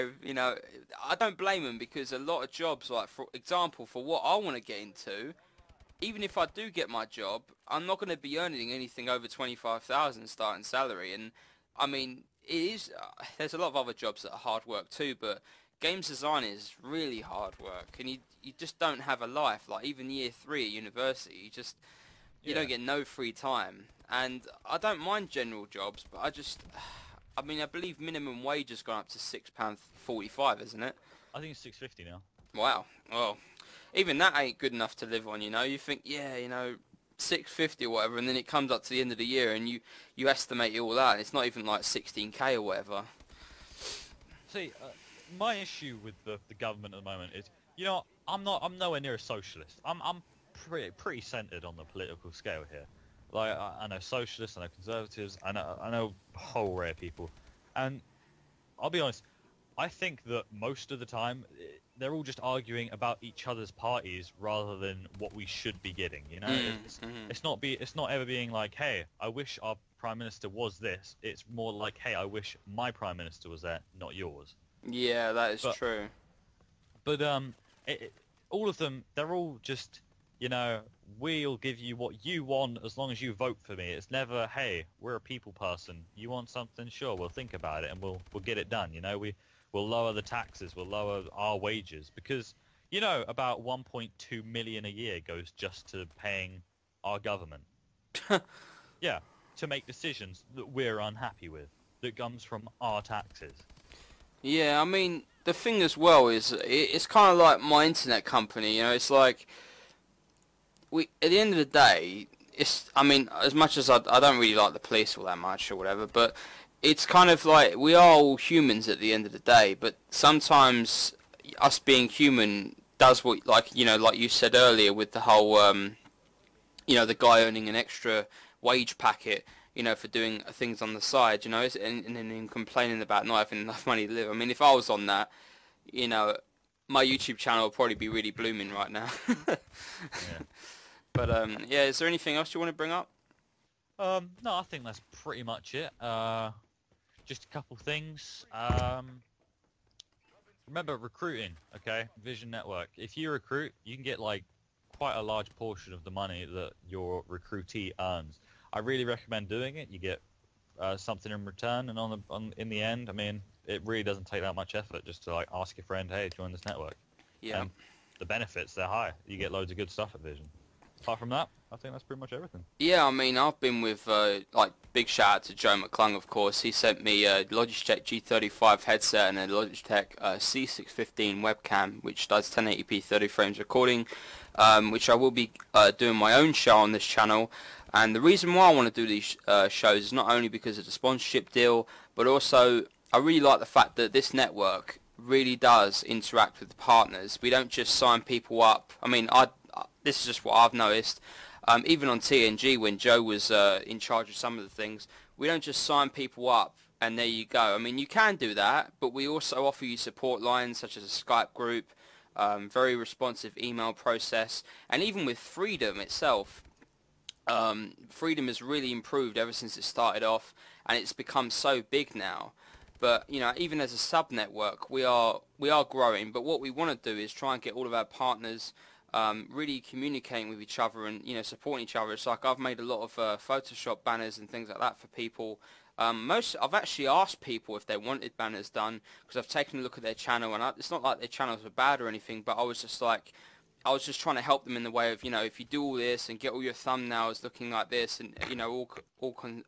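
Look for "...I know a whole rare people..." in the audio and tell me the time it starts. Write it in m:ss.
0:55.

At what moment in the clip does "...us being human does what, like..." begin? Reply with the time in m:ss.
2:01.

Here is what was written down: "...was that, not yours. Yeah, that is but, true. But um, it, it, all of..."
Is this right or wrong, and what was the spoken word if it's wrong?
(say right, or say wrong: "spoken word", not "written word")
right.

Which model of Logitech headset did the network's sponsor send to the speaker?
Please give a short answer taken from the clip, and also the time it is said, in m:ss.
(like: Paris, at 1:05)
G35, at 2:58.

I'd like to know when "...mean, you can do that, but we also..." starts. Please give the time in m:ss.
3:27.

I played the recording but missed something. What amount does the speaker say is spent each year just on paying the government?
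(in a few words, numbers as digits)
1.2 million.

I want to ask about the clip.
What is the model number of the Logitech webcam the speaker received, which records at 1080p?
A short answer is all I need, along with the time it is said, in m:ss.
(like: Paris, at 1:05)
C615, at 3:00.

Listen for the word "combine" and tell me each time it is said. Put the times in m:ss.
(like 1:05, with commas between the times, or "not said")
not said.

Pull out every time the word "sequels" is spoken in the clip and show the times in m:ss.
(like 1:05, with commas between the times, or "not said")
not said.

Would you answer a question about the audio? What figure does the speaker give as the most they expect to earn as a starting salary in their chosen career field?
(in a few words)
25,000.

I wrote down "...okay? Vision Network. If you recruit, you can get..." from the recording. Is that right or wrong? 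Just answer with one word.
right.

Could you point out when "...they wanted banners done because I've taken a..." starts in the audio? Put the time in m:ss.
3:57.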